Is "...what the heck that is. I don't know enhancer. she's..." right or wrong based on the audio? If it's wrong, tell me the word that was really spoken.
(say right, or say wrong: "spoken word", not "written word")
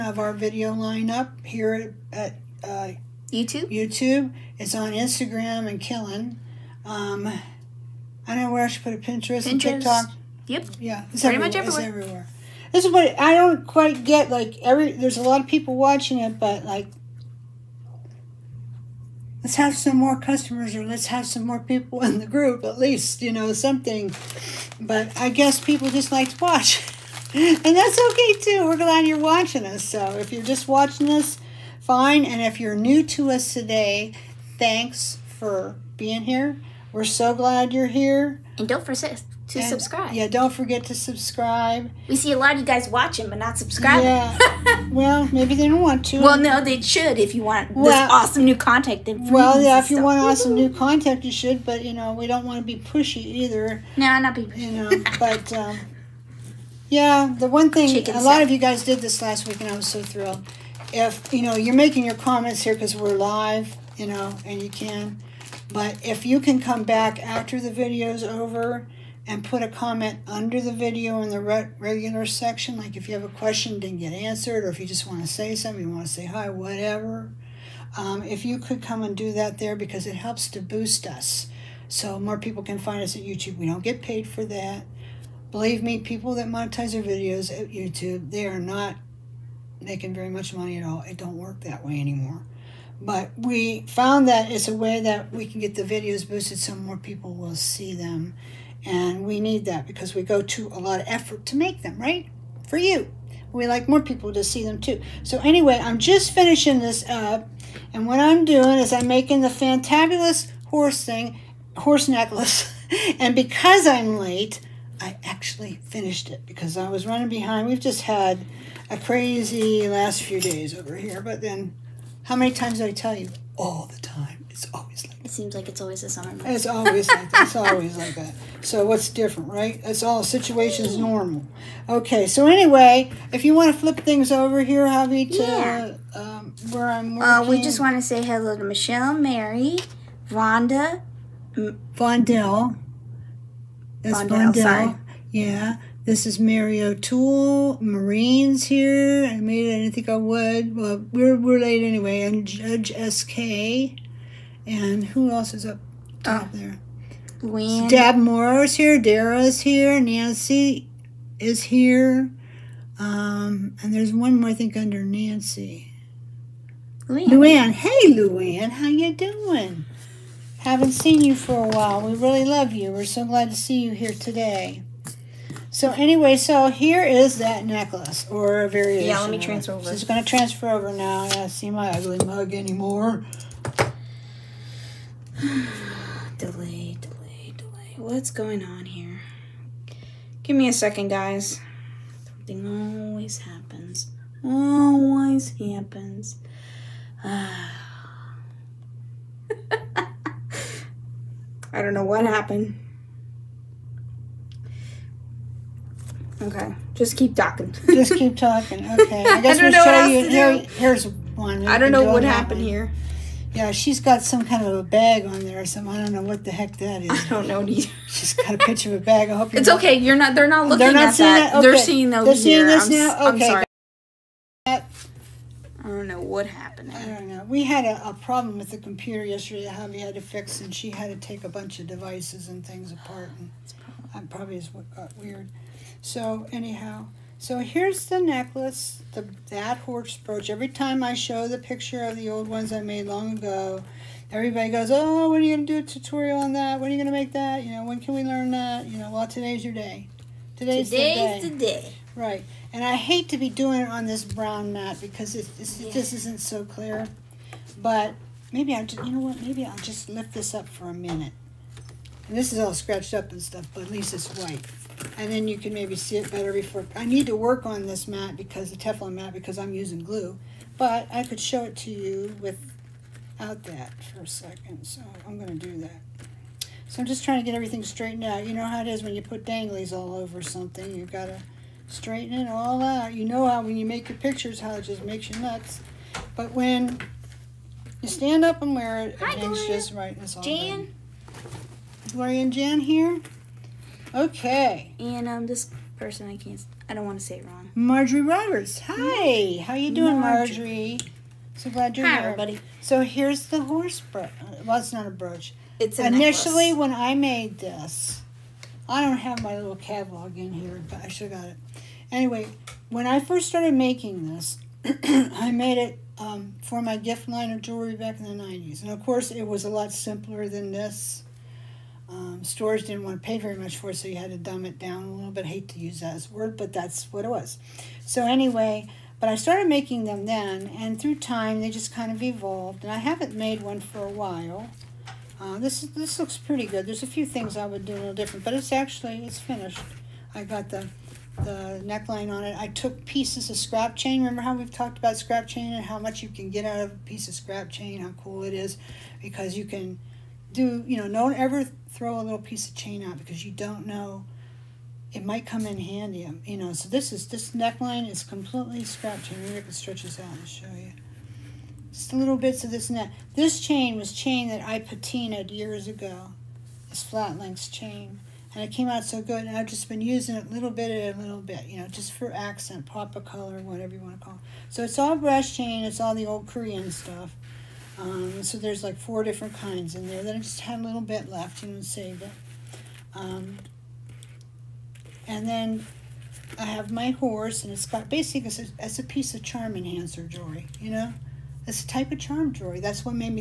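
wrong: "either", not "enhancer".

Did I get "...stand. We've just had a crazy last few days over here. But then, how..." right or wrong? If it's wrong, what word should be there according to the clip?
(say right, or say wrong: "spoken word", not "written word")
wrong: "behind", not "stand".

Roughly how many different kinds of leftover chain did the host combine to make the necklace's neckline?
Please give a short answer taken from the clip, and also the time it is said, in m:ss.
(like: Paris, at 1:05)
4, at 6:18.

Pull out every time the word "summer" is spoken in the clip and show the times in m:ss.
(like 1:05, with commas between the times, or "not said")
2:06.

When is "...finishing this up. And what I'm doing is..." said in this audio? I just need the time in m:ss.
1:46.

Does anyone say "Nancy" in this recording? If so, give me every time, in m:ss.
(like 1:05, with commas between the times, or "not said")
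2:39, 2:45.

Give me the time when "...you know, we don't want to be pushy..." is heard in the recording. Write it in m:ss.
0:51.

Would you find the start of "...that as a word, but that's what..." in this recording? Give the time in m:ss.
5:25.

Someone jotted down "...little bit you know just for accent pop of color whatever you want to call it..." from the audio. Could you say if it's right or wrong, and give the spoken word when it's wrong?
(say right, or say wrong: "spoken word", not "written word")
right.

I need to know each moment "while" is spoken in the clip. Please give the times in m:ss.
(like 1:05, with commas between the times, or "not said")
2:51, 5:34.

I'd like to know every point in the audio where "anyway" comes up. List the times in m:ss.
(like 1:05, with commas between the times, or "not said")
1:45, 2:12, 2:31, 2:55, 5:12, 5:28.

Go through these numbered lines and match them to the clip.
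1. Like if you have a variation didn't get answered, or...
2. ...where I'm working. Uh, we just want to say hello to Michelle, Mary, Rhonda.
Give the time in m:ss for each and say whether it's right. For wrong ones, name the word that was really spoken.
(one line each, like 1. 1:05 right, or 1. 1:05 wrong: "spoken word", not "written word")
1. 1:12 wrong: "question", not "variation"
2. 2:16 right.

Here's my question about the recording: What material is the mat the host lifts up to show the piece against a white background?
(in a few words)
Teflon.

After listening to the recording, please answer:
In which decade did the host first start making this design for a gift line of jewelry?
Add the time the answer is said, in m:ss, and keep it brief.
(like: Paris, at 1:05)
90s, at 5:18.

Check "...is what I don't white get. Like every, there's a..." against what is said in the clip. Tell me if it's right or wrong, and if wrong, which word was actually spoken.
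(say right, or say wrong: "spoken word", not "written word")
wrong: "quite", not "white".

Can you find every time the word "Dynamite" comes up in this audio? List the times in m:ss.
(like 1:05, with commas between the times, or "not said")
not said.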